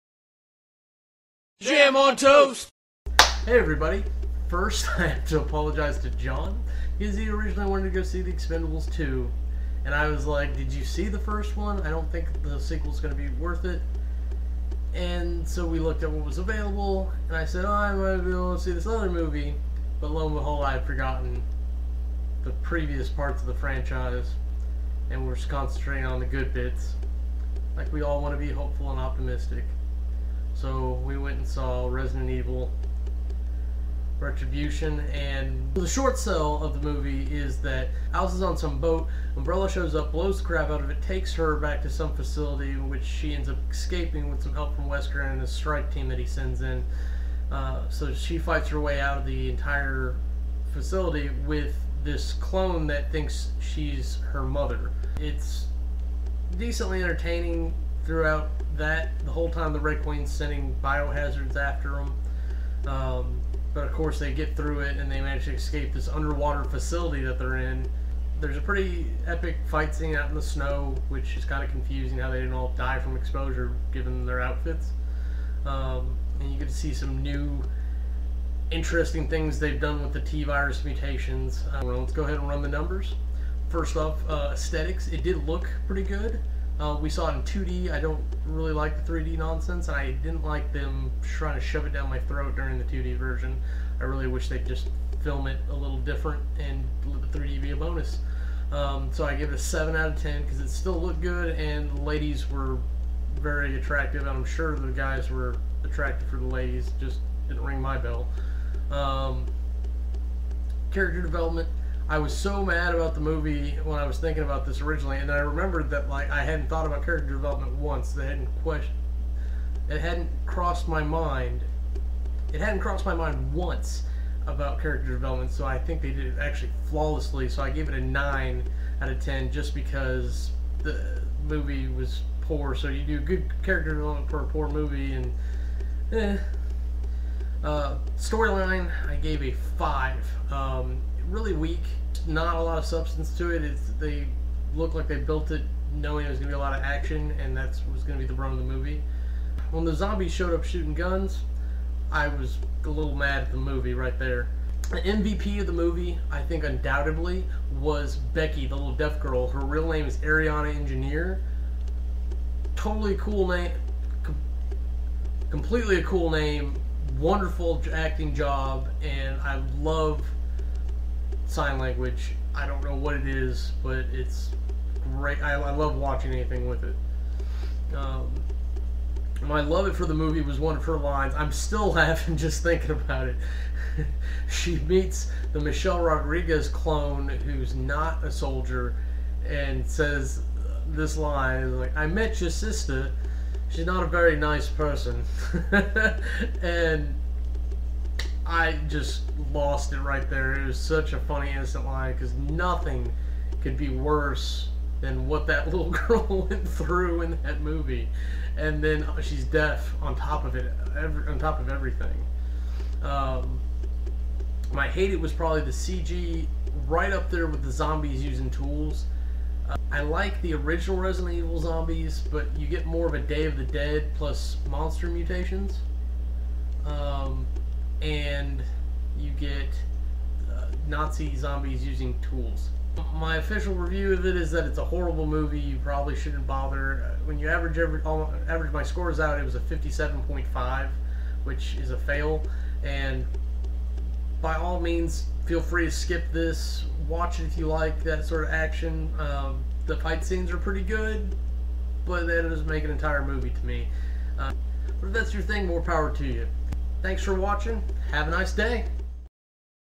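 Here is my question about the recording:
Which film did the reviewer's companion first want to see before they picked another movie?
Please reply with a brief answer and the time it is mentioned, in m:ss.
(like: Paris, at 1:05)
The Expendables 2, at 0:08.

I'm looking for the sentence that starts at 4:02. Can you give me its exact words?
And by all means, feel free to skip this watch it if you like that sort of action.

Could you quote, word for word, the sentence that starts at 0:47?
Uh, so she fights her way out of the entire facility with this clone that thinks she's her mother.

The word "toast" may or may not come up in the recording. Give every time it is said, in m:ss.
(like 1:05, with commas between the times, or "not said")
0:02.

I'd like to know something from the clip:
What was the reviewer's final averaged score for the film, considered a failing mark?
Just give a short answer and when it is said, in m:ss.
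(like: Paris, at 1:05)
57.5, at 3:59.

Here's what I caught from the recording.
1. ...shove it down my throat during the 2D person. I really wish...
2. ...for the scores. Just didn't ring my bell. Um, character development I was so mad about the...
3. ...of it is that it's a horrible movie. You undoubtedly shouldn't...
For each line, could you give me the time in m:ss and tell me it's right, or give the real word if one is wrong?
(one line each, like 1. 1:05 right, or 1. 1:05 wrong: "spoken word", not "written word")
1. 1:31 wrong: "version", not "person"
2. 1:46 wrong: "ladies", not "scores"
3. 3:54 wrong: "probably", not "undoubtedly".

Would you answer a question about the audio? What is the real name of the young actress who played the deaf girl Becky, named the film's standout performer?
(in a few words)
Aryana Engineer.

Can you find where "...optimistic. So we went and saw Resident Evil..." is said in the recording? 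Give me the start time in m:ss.
0:28.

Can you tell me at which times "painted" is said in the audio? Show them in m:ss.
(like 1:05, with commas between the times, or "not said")
not said.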